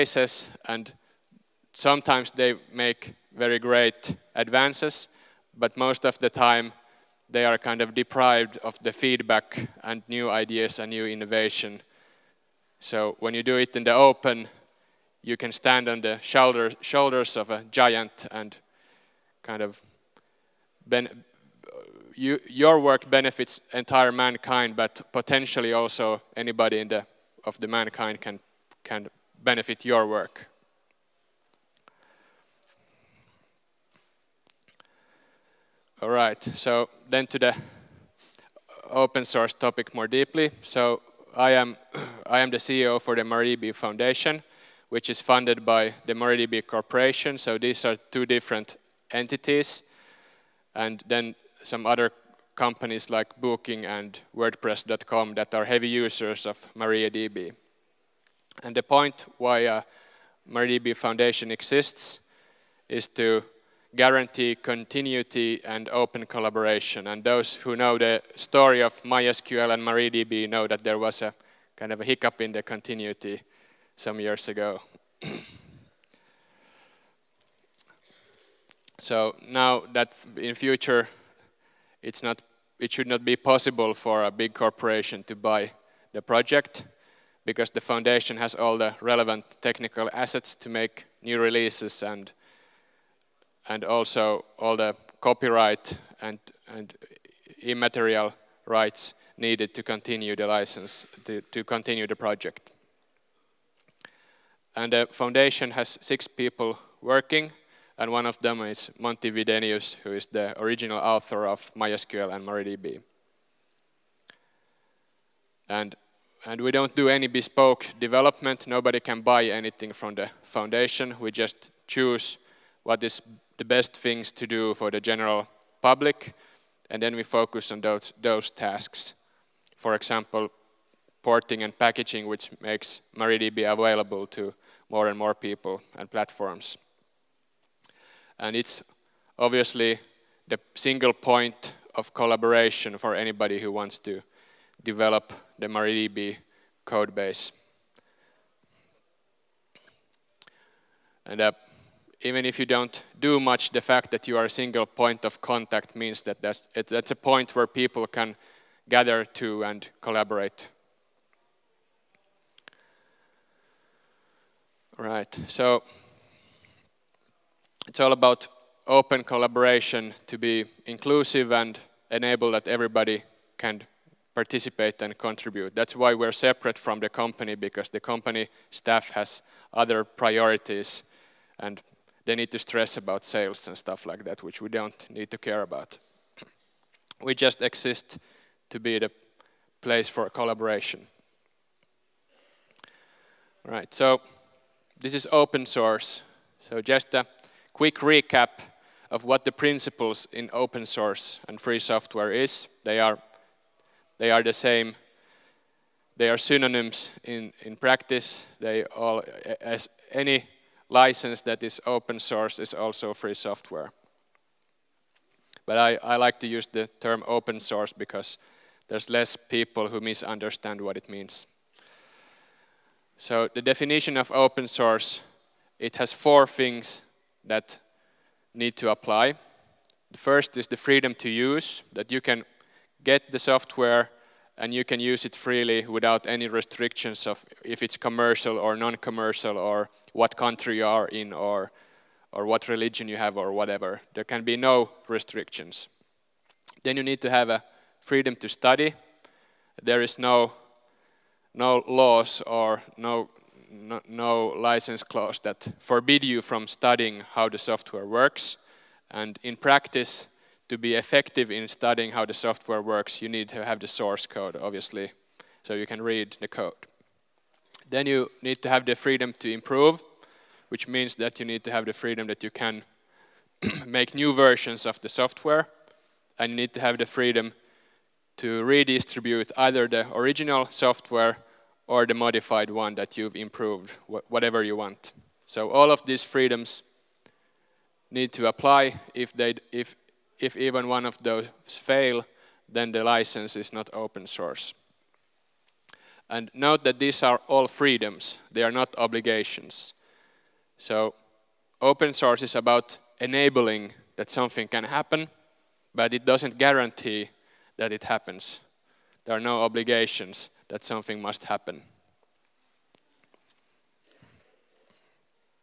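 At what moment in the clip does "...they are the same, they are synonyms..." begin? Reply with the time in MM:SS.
03:24.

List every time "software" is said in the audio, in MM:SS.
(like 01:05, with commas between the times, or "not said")
03:21, 03:33, 03:53, 04:17, 04:22, 04:35, 04:40.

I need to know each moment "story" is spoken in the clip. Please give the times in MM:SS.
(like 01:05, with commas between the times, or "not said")
01:08.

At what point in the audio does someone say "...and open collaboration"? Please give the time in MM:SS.
01:05.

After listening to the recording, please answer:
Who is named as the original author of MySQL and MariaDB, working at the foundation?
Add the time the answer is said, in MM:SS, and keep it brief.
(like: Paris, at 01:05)
Monty Widenius, at 01:48.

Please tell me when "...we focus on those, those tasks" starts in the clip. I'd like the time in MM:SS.
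02:07.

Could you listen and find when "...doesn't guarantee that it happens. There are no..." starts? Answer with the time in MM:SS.
05:06.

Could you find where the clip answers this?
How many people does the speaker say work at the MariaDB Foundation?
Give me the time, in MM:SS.
01:46.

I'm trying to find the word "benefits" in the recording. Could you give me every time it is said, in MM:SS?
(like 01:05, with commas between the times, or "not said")
00:23, 00:29.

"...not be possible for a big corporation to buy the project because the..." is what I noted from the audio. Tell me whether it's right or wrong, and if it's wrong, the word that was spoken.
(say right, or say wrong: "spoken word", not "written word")
right.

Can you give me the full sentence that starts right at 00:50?
And then some other companies like Booking and WordPress.com that are heavy users of MariaDB.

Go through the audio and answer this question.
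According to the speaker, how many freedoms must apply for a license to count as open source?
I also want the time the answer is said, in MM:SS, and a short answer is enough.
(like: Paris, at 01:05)
4, at 03:46.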